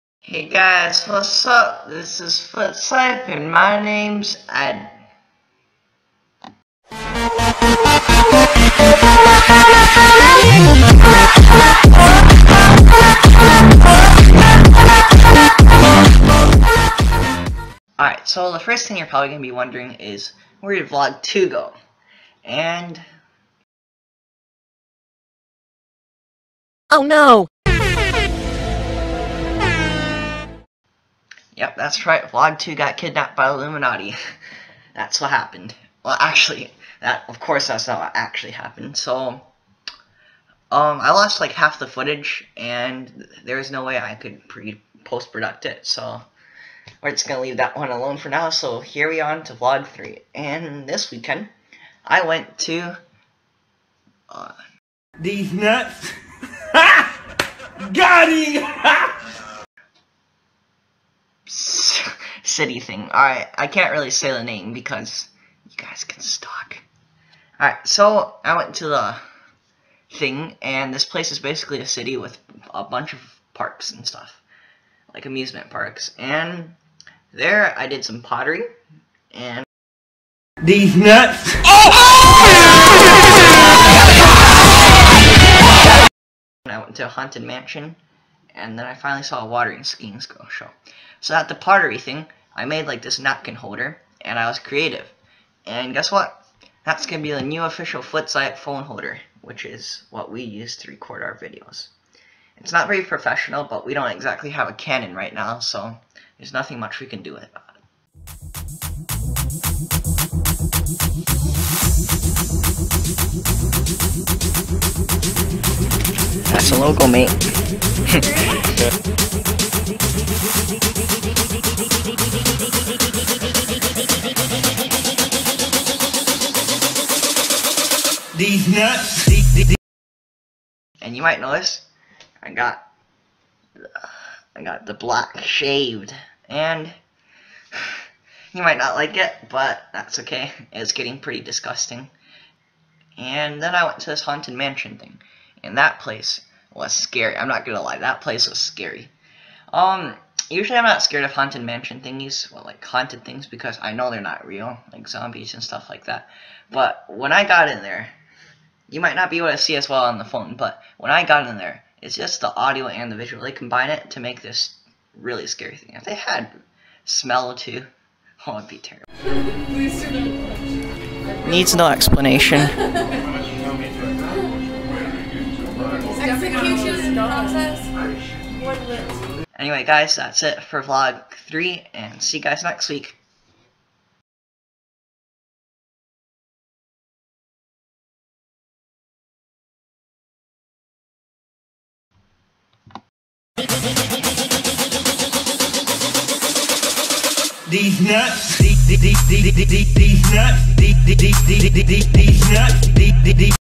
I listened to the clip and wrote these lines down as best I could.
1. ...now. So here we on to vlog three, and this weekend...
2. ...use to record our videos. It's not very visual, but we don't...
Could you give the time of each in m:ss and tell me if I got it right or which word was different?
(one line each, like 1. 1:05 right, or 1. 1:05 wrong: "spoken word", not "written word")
1. 0:48 right
2. 1:40 wrong: "professional", not "visual".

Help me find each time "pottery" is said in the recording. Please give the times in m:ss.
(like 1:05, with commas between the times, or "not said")
1:18, 1:31.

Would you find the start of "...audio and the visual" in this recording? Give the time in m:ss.
2:42.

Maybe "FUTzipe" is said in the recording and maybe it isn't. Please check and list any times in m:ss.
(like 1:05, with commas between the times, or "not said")
0:02, 1:38.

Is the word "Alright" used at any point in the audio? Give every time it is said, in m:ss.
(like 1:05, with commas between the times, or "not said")
0:17, 1:07.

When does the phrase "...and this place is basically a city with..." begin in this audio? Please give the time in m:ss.
1:10.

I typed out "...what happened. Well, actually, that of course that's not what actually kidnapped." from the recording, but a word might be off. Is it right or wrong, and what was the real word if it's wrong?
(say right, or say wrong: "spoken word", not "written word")
wrong: "happened", not "kidnapped".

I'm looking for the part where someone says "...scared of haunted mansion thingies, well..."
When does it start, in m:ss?
2:31.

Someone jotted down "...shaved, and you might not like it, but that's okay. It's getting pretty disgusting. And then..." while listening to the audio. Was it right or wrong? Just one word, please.
right.